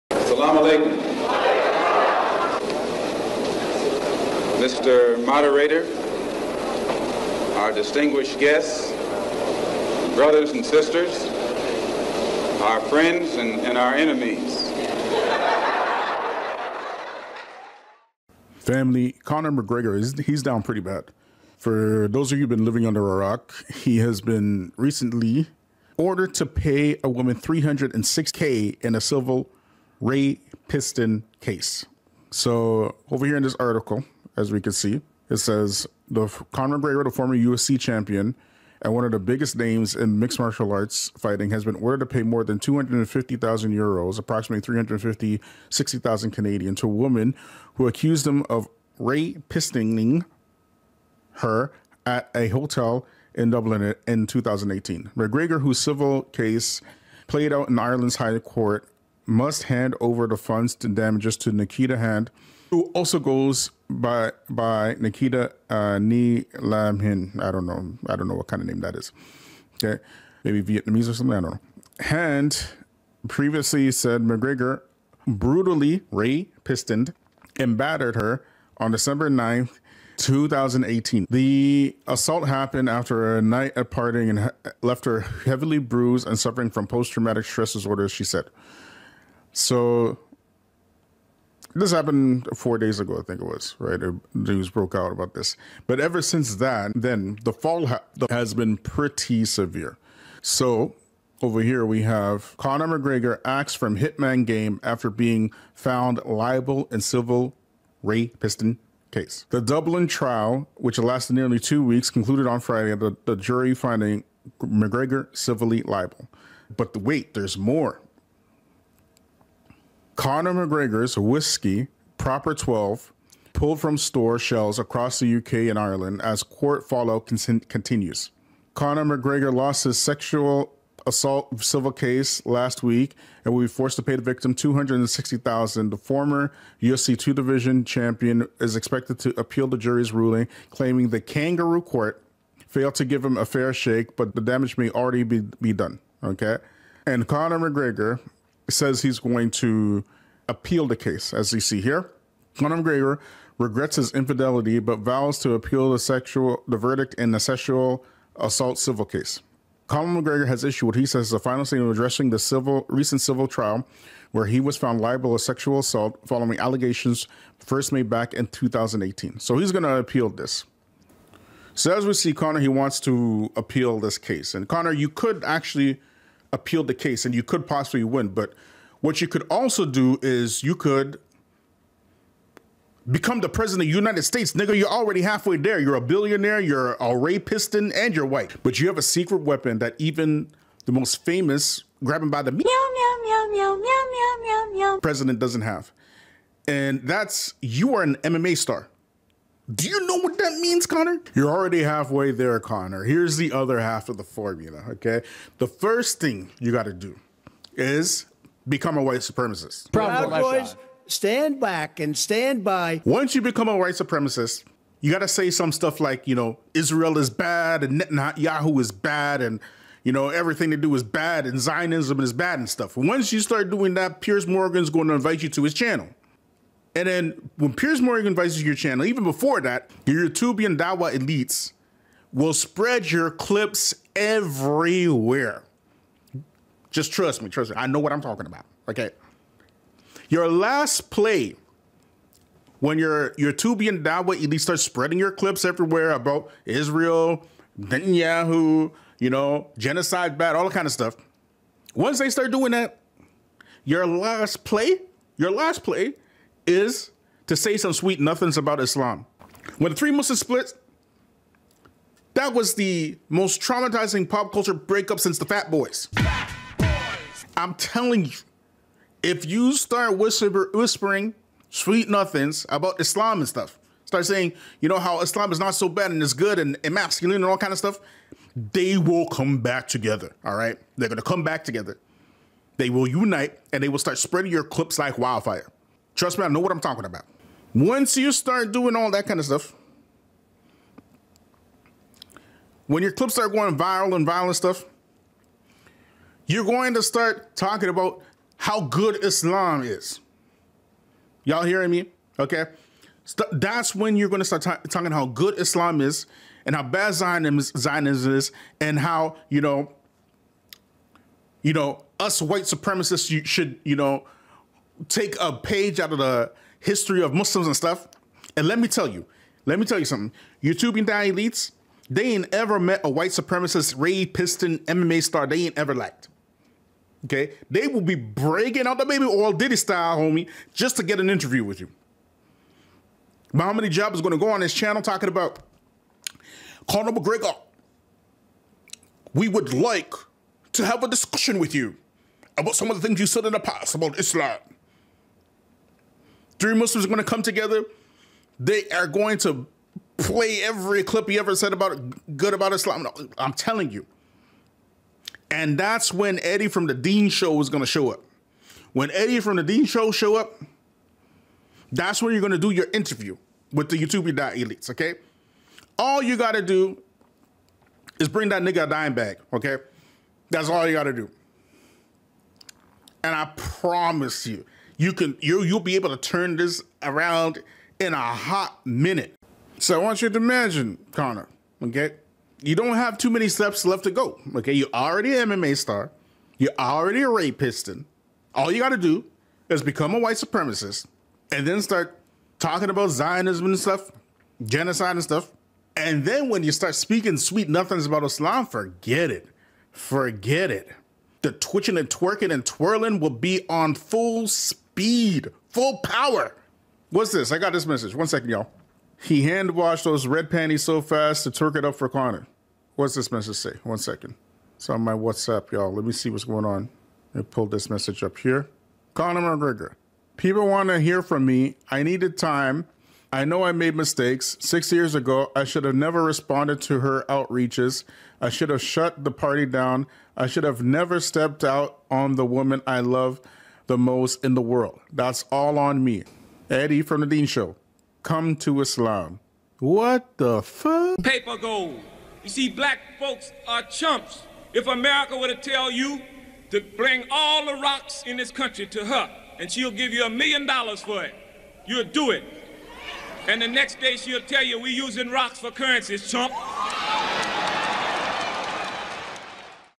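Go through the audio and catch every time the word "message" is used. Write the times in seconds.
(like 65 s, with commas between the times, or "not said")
407 s, 413 s, 417 s.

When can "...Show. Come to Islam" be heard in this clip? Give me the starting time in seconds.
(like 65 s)
437 s.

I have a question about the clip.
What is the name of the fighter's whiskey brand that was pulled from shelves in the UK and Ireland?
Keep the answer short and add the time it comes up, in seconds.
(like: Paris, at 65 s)
Proper 12, at 122 s.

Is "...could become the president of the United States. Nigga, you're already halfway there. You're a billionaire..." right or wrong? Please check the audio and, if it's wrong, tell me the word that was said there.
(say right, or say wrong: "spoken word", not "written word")
right.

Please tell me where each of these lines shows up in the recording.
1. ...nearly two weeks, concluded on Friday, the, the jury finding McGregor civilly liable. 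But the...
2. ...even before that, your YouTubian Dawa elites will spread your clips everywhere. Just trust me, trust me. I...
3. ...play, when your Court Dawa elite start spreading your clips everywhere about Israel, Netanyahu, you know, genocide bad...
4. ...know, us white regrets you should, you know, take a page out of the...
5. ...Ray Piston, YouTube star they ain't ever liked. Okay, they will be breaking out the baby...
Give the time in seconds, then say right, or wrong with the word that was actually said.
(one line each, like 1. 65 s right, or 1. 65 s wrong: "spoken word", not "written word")
1. 111 s right
2. 229 s right
3. 241 s wrong: "YouTubian", not "Court"
4. 311 s wrong: "supremacists", not "regrets"
5. 323 s wrong: "MMA", not "YouTube".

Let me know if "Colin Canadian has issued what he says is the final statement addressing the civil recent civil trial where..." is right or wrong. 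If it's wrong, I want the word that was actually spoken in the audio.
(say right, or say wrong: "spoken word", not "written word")
wrong: "McGregor", not "Canadian".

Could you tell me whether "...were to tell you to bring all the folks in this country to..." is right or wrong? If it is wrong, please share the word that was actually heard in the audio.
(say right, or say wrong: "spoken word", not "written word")
wrong: "rocks", not "folks".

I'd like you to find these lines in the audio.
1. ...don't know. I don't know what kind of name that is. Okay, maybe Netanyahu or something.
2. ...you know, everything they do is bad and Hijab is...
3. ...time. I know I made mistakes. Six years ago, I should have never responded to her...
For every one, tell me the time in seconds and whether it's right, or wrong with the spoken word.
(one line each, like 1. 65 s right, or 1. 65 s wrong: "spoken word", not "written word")
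1. 67 s wrong: "Vietnamese", not "Netanyahu"
2. 220 s wrong: "Zionism", not "Hijab"
3. 422 s right.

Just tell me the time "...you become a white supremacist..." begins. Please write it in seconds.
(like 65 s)
213 s.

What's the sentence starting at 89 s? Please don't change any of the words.
So this happened four days ago, I think it was, right?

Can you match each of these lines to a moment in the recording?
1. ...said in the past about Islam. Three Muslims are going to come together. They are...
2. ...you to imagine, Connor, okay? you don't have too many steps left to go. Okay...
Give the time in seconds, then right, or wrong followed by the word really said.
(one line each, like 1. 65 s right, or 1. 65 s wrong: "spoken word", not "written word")
1. 343 s right
2. 380 s right.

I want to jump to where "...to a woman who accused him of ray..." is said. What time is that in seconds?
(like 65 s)
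46 s.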